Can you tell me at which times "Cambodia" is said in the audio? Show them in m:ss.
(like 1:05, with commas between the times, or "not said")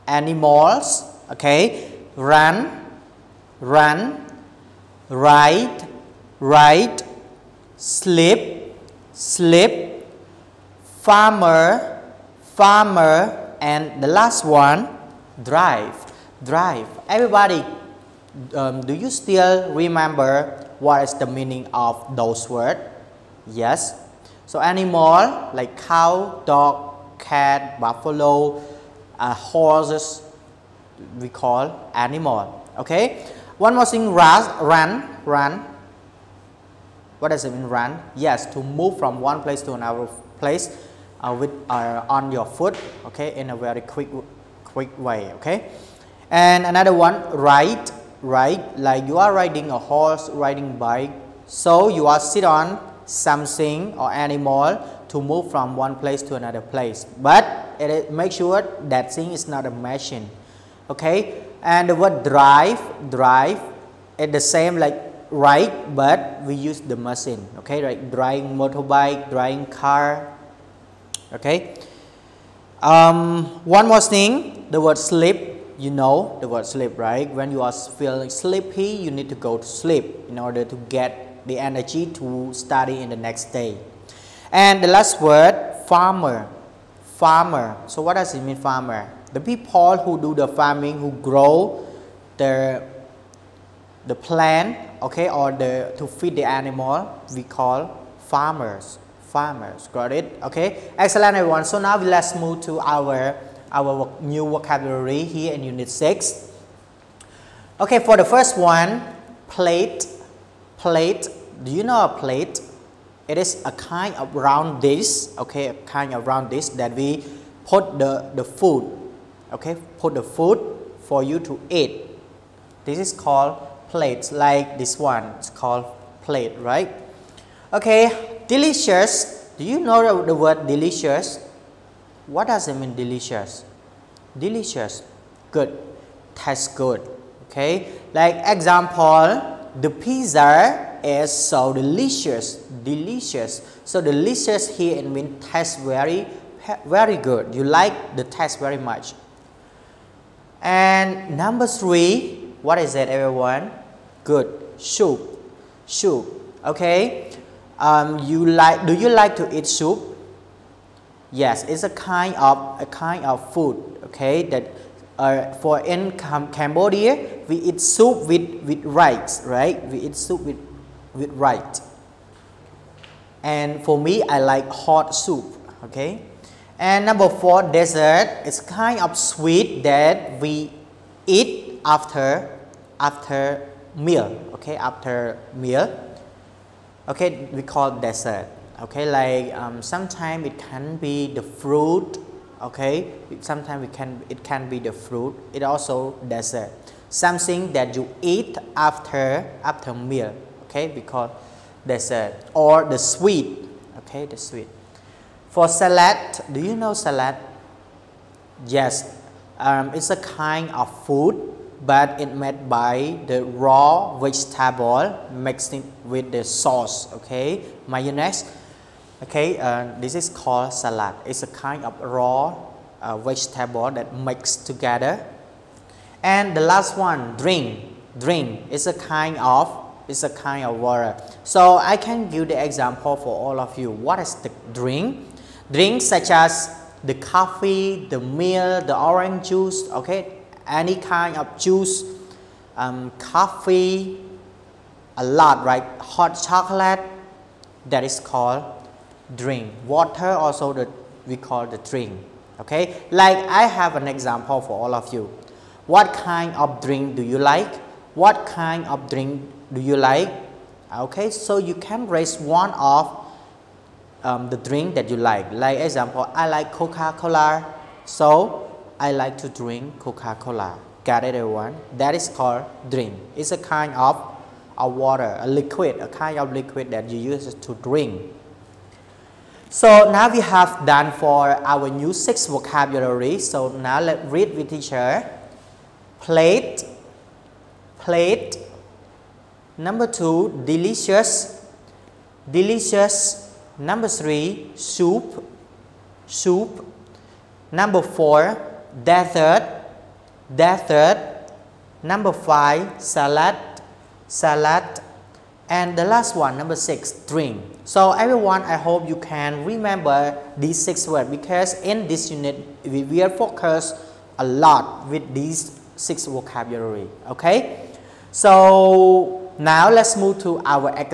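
2:46.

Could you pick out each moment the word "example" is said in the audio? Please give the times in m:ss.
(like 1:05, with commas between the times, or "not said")
2:18, 3:52, 4:14, 4:25.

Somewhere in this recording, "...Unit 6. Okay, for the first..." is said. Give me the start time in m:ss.
1:45.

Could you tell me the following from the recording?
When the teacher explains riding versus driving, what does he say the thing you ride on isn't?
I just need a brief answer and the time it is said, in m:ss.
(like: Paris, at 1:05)
a machine, at 0:59.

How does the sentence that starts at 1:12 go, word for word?
Um, one more thing, the word sleep, you know the word sleep, right?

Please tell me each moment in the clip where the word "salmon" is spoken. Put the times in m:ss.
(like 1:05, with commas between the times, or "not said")
not said.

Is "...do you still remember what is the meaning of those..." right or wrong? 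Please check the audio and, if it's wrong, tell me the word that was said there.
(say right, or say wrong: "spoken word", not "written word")
right.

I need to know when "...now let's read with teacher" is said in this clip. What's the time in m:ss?
4:43.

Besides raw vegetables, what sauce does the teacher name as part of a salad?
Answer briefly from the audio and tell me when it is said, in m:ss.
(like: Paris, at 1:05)
mayonnaise, at 3:37.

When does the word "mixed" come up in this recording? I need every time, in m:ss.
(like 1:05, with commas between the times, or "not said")
3:35, 3:44.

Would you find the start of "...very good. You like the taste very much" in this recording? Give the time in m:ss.
2:26.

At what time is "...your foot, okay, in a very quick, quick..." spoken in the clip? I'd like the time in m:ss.
0:42.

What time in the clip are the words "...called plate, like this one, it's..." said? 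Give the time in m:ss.
2:03.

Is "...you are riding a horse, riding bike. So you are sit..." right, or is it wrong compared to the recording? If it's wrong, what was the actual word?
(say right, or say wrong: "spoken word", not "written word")
right.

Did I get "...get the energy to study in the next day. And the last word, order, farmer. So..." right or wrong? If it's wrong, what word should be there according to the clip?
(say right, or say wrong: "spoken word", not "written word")
wrong: "farmer", not "order".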